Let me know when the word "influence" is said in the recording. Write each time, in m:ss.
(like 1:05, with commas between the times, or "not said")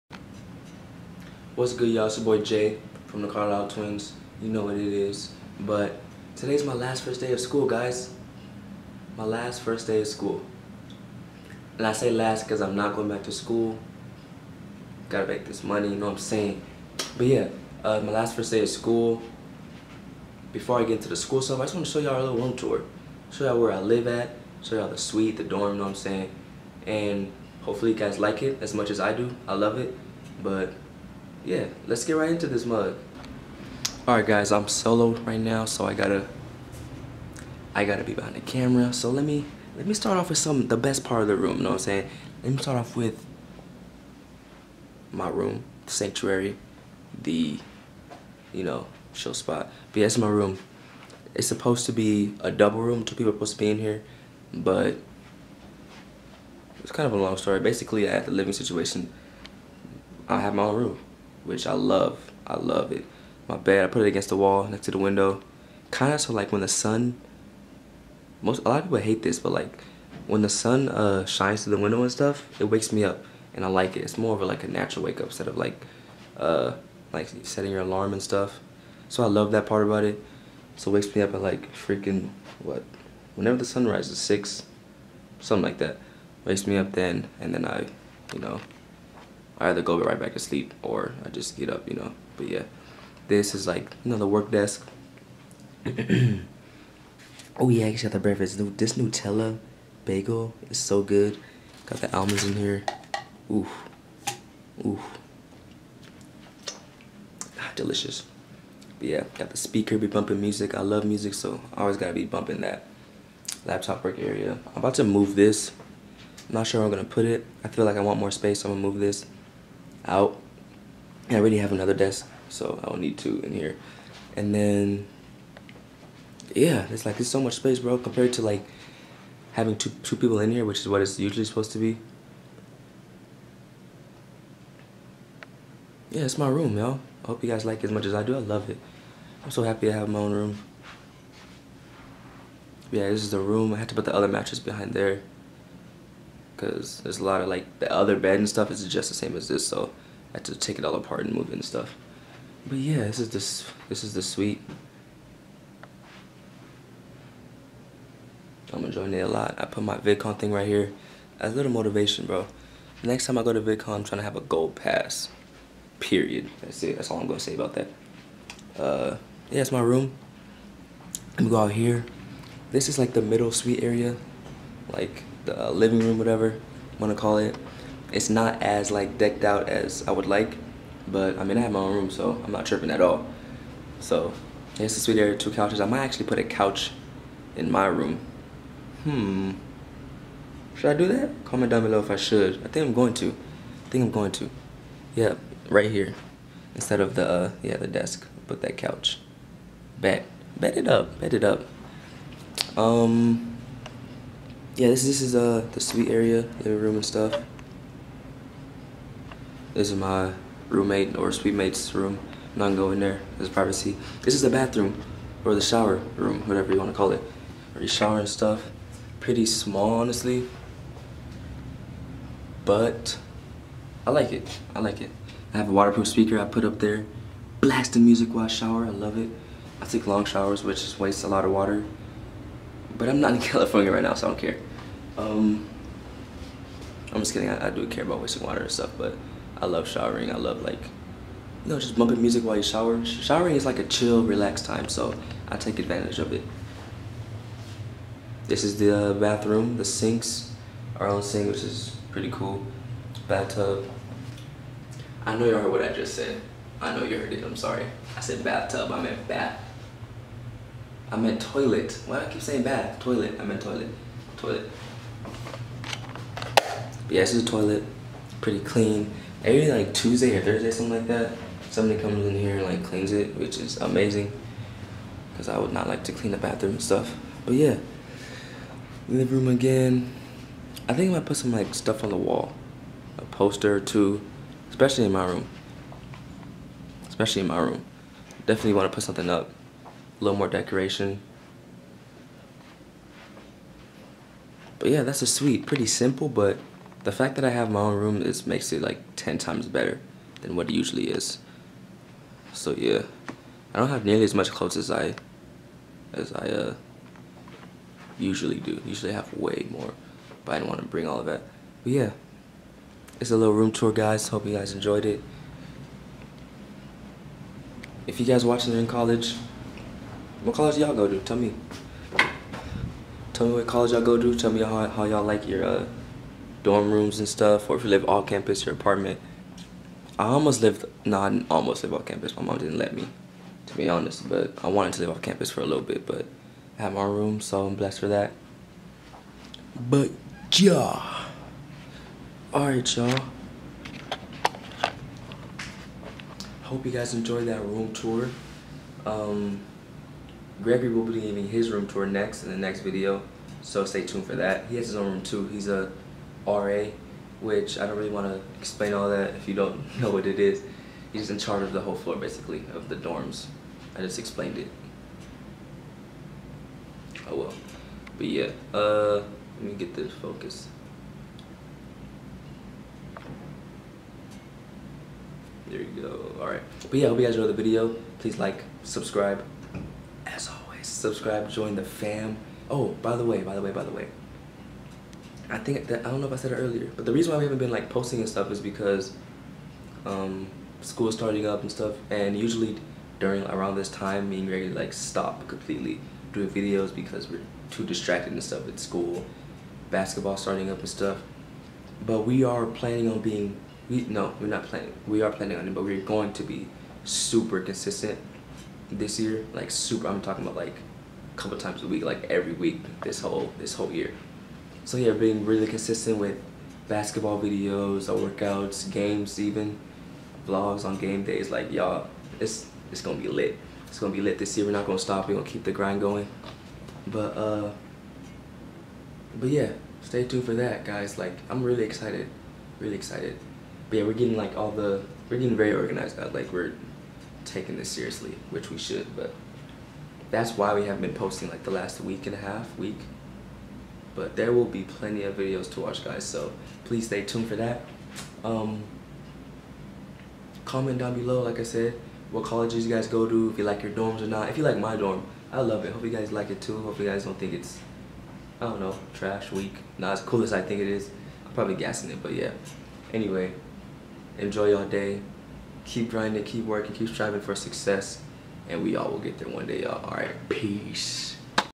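not said.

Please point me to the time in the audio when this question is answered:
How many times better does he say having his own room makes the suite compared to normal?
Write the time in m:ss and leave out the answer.
4:59.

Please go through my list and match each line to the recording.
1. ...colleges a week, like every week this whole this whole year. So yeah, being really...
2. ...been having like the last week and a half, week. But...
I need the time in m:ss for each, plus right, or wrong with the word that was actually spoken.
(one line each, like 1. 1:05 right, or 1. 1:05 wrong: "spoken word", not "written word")
1. 6:51 wrong: "times", not "colleges"
2. 7:21 wrong: "posting", not "having".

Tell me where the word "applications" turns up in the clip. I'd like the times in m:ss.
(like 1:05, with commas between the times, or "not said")
not said.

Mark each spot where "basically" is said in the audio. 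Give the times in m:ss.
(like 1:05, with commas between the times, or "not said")
0:57, 6:02.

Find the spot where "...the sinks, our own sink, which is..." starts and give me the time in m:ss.
4:09.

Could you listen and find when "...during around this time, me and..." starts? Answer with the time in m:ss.
6:33.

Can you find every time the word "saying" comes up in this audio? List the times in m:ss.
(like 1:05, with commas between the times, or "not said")
0:16, 0:25, 0:41, 4:22.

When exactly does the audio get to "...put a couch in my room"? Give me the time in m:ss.
3:06.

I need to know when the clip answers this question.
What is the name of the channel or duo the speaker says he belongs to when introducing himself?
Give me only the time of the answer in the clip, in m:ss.
0:03.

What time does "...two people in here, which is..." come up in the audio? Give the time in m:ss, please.
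2:10.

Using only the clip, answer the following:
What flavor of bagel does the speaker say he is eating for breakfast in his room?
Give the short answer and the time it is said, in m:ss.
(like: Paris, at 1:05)
Nutella, at 1:38.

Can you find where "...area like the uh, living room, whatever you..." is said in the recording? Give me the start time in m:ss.
2:53.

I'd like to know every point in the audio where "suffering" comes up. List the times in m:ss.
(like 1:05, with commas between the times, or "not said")
not said.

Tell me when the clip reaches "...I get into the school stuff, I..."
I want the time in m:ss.
0:20.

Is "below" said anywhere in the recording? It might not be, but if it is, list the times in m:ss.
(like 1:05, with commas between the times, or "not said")
3:11, 7:31.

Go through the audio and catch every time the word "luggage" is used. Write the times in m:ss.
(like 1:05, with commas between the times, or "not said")
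not said.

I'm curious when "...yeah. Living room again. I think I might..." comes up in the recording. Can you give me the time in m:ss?
4:37.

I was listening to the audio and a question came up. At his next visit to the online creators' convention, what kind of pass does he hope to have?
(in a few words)
gold pass.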